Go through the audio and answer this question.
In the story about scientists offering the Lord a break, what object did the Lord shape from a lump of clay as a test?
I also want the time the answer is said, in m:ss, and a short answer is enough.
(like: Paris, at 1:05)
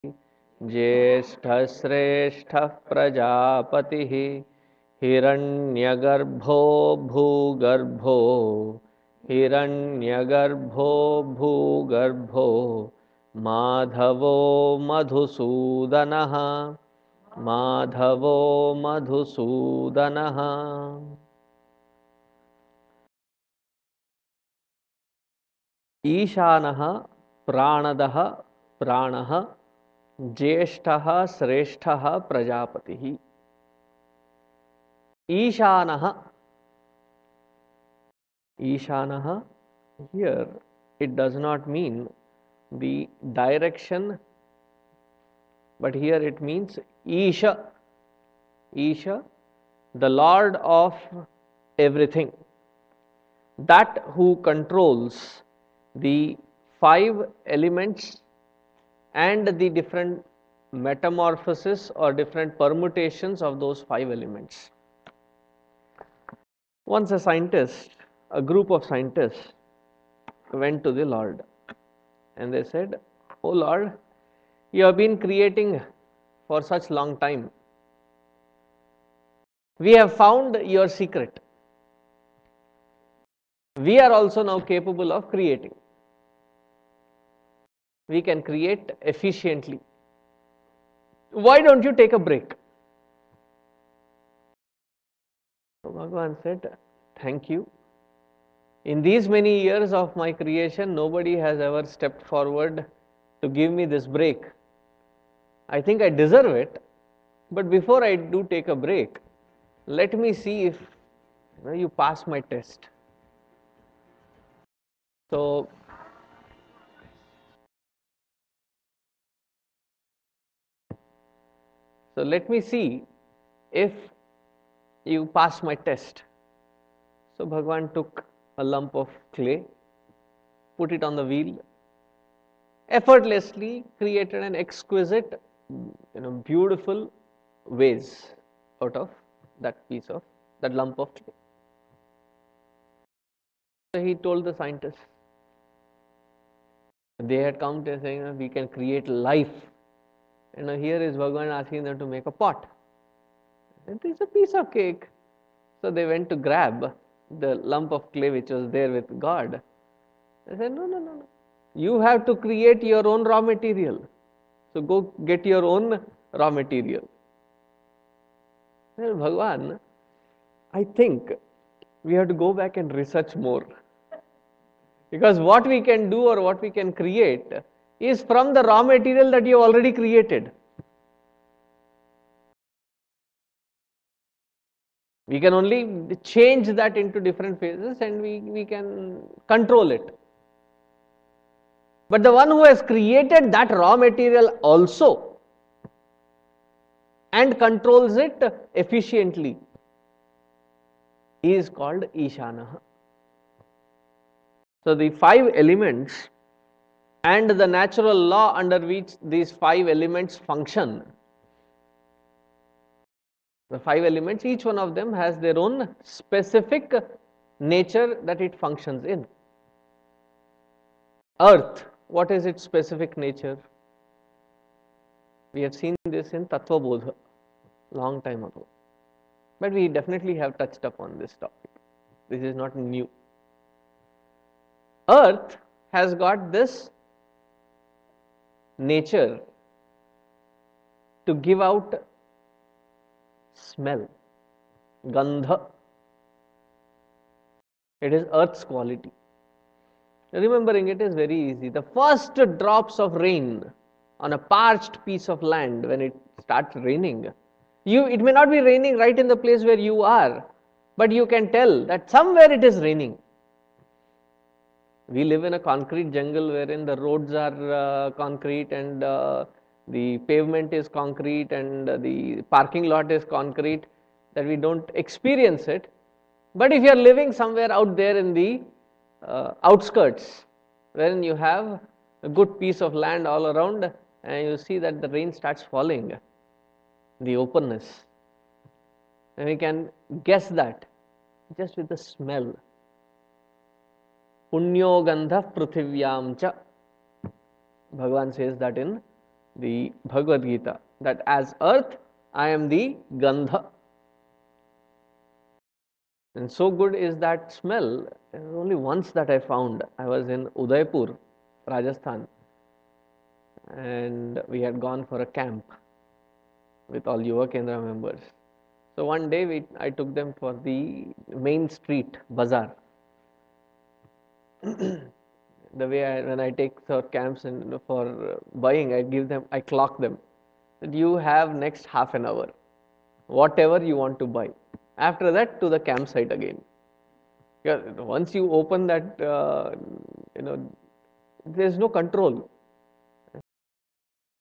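vase, at 2:17.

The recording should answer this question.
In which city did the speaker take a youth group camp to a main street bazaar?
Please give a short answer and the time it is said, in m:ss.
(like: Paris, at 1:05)
Udaipur, at 5:10.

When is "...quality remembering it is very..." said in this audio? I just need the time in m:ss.
4:08.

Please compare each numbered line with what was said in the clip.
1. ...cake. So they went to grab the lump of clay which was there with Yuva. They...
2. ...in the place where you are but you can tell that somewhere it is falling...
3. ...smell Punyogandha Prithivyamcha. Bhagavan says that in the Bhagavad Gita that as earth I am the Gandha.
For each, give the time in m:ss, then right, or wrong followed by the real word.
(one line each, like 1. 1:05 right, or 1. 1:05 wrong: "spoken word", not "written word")
1. 2:34 wrong: "God", not "Yuva"
2. 4:19 wrong: "raining", not "falling"
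3. 4:51 right.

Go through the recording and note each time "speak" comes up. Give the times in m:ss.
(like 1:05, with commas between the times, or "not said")
not said.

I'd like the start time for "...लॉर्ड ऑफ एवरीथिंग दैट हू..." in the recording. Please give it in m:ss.
0:50.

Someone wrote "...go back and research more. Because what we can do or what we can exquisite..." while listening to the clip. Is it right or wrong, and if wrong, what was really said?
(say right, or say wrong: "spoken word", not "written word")
wrong: "create", not "exquisite".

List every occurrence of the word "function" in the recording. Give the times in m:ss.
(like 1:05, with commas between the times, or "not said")
3:30, 3:38.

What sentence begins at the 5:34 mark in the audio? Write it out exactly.
After that, to the campsite again.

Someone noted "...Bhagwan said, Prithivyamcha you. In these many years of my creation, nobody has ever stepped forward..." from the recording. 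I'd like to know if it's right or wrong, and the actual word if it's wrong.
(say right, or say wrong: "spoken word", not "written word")
wrong: "Thank", not "Prithivyamcha".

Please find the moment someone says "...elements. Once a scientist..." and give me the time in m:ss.
1:04.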